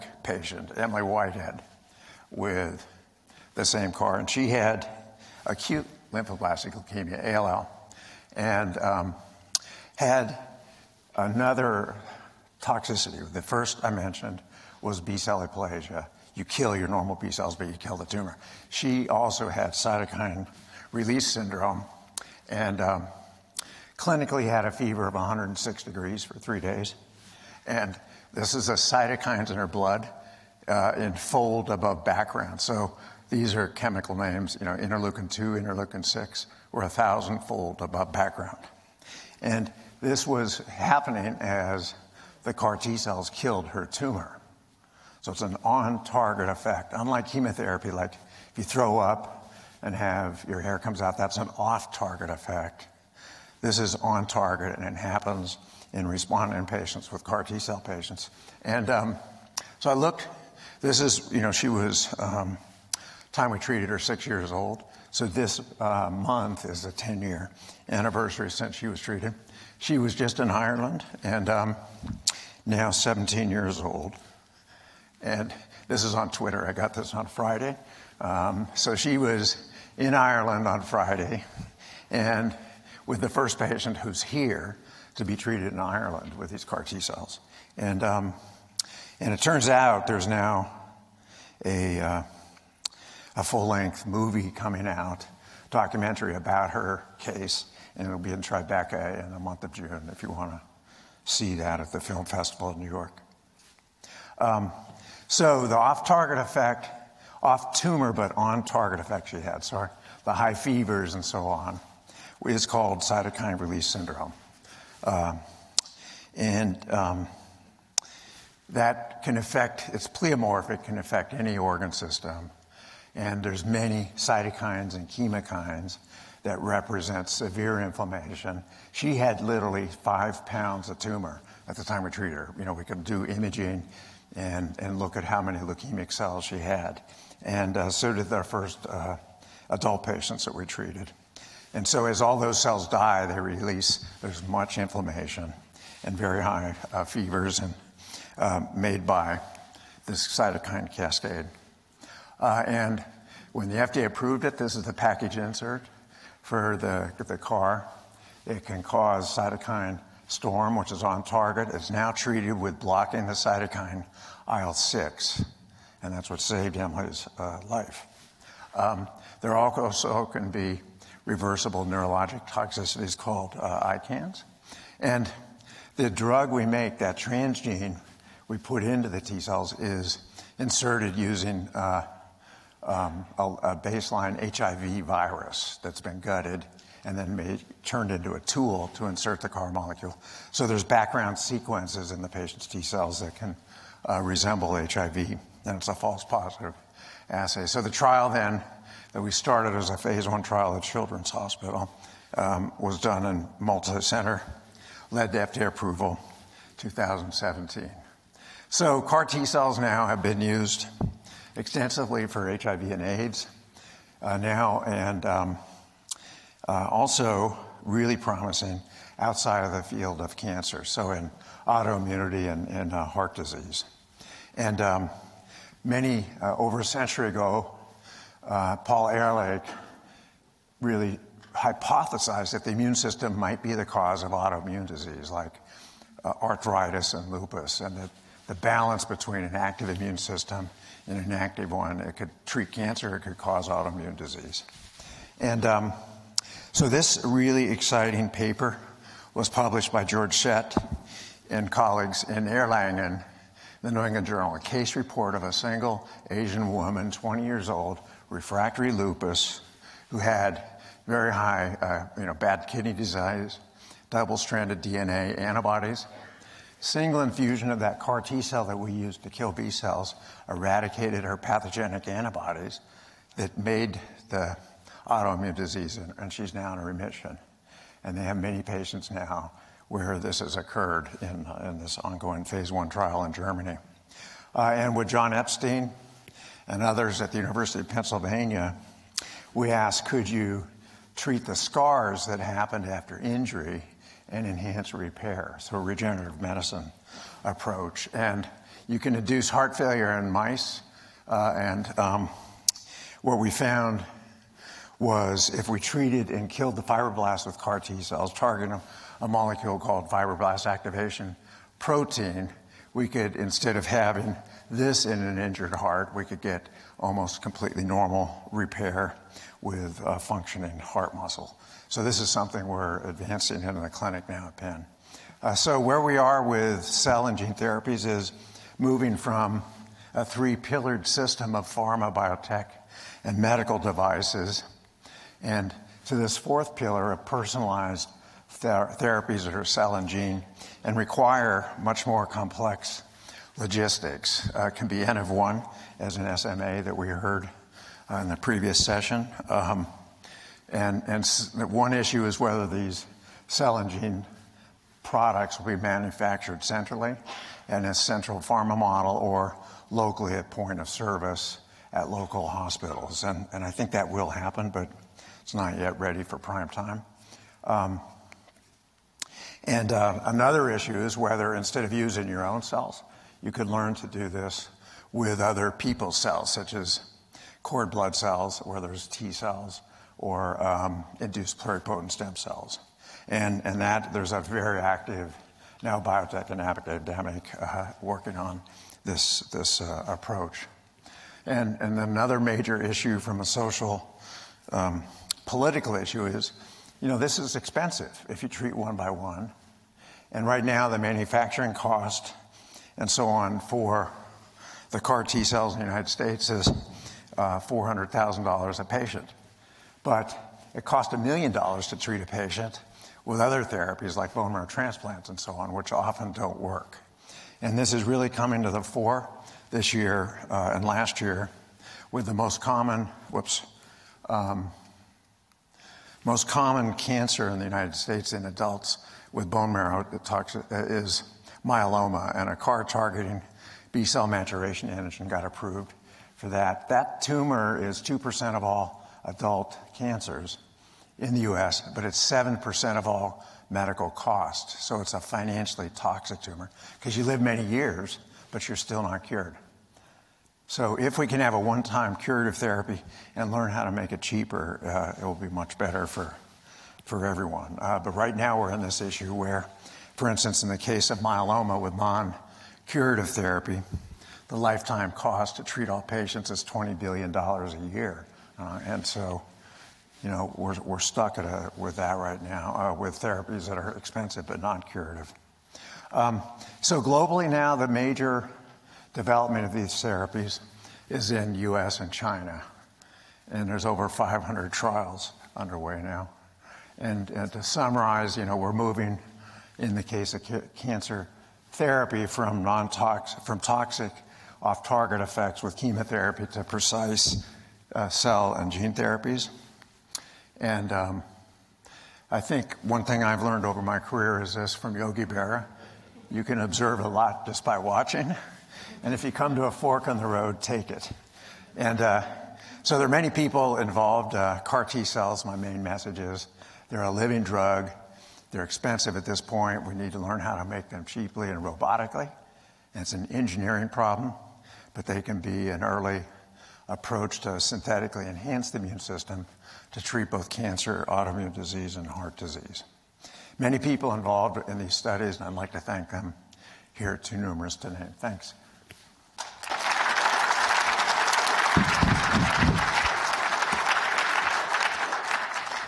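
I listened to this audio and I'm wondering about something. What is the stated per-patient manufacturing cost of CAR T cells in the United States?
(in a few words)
$400,000.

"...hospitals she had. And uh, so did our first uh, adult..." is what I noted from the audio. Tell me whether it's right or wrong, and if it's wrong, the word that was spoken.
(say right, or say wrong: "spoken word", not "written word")
wrong: "cells", not "hospitals".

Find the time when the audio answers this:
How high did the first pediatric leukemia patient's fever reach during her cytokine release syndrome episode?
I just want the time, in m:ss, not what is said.
0:25.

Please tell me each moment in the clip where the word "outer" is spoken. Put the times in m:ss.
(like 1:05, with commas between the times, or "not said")
not said.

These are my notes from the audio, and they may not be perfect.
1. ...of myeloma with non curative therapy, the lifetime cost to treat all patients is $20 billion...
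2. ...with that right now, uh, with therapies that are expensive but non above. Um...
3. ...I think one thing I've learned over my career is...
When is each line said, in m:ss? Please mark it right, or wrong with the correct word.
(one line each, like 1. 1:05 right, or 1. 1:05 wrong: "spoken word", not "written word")
1. 7:41 right
2. 7:51 wrong: "curative", not "above"
3. 8:22 right.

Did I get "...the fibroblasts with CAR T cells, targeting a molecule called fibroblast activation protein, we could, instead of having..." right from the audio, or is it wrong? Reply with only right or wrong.
right.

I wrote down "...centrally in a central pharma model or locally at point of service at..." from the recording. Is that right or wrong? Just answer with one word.
right.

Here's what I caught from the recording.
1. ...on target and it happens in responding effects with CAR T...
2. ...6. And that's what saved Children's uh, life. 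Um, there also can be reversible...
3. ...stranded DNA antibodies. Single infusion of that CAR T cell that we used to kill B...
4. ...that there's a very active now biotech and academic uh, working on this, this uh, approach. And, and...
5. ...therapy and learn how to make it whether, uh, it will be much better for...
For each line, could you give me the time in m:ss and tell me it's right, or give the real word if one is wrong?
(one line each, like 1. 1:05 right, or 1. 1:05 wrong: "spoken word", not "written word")
1. 0:53 wrong: "patients", not "effects"
2. 2:44 wrong: "Emily", not "Children"
3. 4:24 right
4. 6:23 right
5. 7:32 wrong: "cheaper", not "whether".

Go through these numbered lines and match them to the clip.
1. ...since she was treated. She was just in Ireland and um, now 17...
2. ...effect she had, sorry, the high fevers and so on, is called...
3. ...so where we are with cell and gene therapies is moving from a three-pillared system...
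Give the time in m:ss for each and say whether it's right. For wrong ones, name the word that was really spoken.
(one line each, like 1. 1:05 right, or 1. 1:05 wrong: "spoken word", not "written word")
1. 1:08 right
2. 1:48 right
3. 5:25 right.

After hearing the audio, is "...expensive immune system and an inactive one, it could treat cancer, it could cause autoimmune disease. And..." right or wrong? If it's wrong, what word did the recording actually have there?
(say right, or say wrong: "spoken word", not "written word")
wrong: "active", not "expensive".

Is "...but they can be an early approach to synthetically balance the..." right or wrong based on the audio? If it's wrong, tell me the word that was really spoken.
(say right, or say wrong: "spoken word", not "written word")
wrong: "enhance", not "balance".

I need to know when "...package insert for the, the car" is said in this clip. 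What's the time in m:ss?
2:34.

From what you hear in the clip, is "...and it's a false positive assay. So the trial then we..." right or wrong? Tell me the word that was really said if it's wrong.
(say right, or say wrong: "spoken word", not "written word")
right.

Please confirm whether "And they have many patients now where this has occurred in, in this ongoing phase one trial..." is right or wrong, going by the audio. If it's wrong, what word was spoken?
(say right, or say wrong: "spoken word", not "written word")
right.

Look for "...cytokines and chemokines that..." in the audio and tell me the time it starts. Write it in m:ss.
2:04.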